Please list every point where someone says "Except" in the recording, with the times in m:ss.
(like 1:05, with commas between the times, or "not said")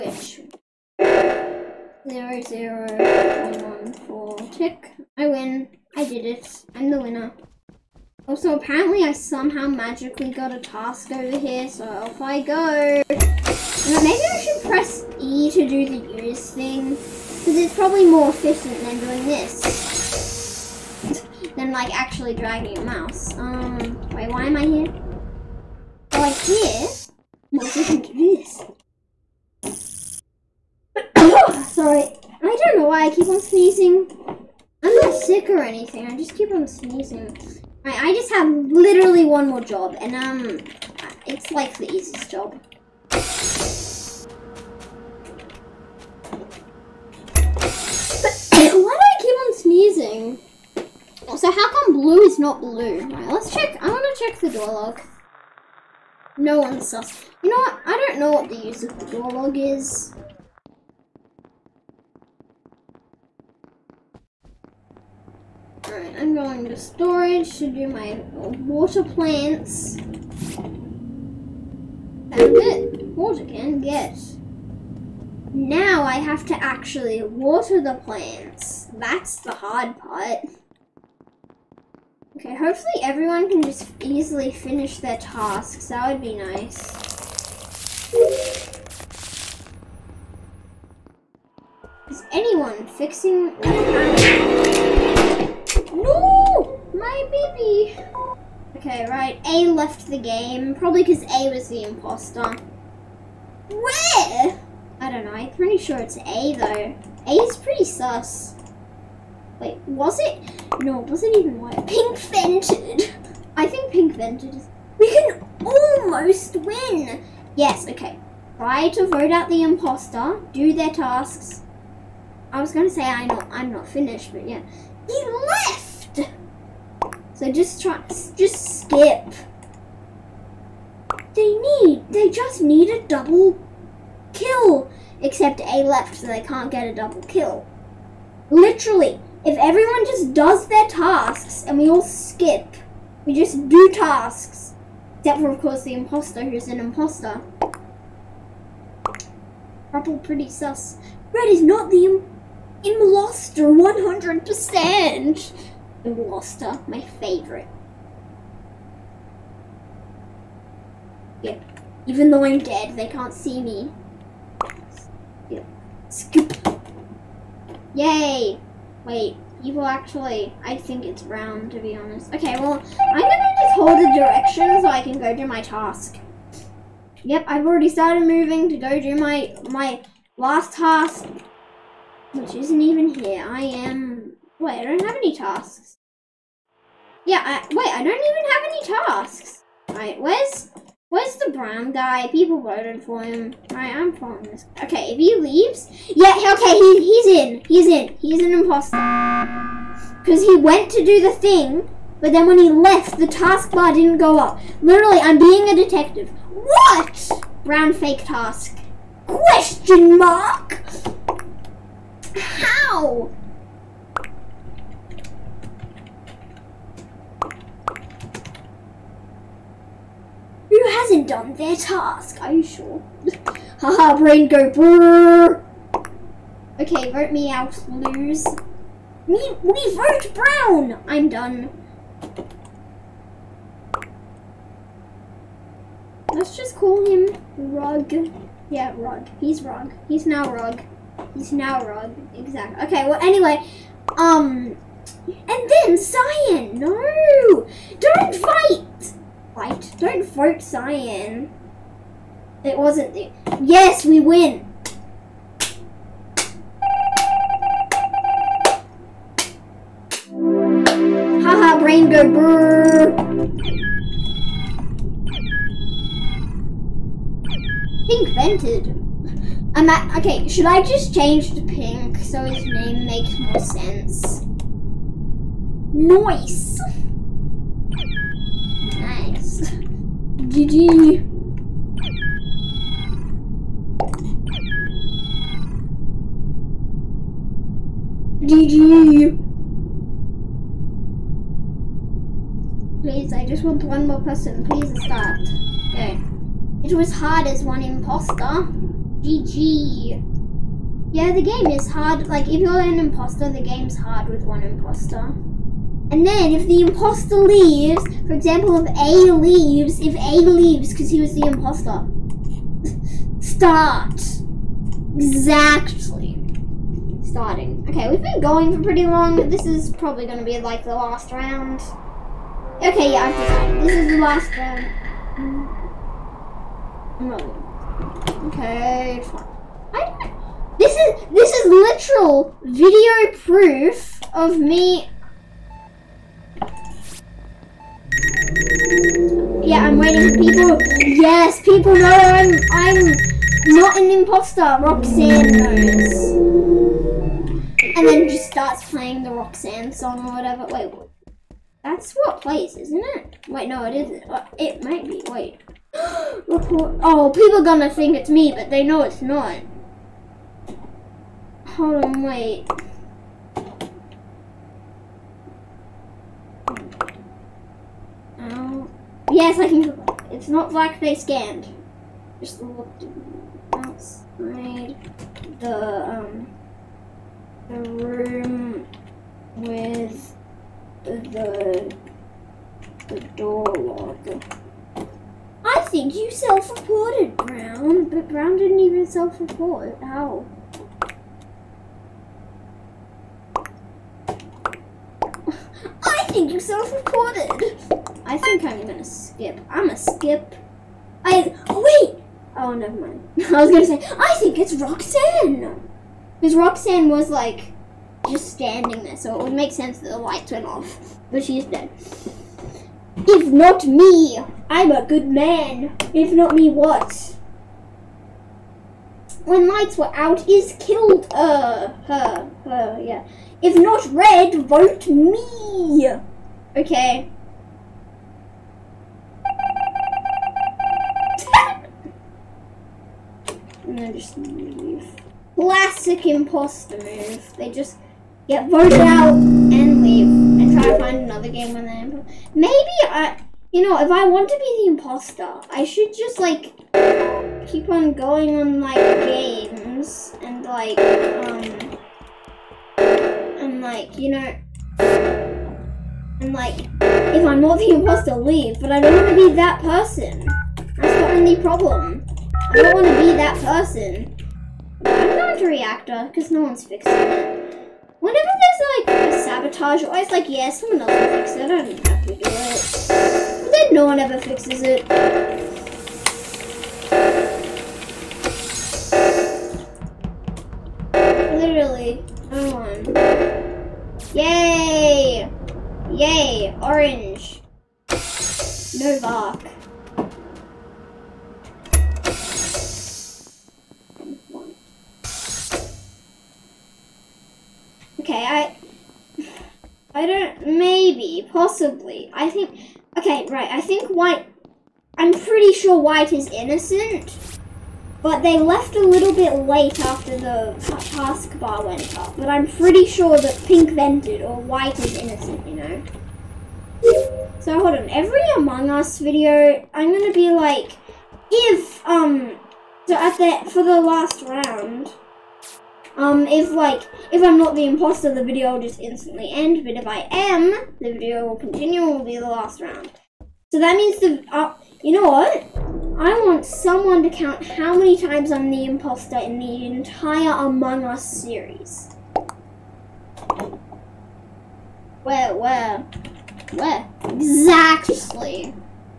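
2:15, 2:25.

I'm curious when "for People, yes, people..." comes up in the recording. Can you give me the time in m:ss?
5:40.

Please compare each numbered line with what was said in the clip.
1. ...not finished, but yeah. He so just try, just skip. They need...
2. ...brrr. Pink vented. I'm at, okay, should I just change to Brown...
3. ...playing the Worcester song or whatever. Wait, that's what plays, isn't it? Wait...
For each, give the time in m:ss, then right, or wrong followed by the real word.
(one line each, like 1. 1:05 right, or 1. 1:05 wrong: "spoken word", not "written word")
1. 2:03 right
2. 4:22 wrong: "Pink", not "Brown"
3. 5:48 wrong: "Roxanne", not "Worcester".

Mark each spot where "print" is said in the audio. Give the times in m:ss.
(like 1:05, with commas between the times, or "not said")
not said.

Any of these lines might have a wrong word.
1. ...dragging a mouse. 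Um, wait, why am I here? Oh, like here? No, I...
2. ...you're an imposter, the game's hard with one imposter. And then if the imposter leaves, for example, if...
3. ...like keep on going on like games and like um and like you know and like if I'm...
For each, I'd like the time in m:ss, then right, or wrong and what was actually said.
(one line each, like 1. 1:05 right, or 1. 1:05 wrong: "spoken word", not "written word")
1. 0:22 right
2. 5:02 right
3. 7:26 right.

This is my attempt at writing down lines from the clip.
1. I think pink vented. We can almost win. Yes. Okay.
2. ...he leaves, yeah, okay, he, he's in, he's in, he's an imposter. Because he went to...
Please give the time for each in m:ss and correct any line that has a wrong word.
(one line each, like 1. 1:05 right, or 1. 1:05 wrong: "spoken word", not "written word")
1. 1:53 right
2. 3:15 right.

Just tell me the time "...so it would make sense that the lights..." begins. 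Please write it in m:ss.
6:49.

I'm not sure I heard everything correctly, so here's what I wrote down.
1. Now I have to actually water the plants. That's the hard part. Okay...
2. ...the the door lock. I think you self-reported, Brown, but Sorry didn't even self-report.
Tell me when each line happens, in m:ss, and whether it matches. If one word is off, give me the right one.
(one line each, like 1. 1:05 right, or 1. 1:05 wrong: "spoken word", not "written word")
1. 1:15 right
2. 6:21 wrong: "Brown", not "Sorry".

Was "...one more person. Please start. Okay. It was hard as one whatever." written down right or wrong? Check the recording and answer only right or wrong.
wrong.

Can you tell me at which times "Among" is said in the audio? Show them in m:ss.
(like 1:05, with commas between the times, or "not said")
8:38, 9:00.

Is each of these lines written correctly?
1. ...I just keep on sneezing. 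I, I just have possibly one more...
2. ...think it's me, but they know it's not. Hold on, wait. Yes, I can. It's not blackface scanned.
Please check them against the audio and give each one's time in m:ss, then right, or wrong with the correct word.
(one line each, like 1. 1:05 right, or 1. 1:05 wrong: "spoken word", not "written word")
1. 0:36 wrong: "literally", not "possibly"
2. 5:57 right.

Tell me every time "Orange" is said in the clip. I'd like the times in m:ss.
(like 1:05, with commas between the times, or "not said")
8:06.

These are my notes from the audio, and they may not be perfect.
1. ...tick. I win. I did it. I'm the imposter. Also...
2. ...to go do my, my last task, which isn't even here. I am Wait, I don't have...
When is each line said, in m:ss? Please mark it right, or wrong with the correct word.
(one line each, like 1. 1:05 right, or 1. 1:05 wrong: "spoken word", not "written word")
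1. 0:04 wrong: "winner", not "imposter"
2. 2:58 right.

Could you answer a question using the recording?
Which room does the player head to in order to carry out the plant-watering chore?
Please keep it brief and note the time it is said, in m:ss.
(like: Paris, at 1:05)
Storage, at 1:06.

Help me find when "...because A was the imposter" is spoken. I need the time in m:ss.
1:41.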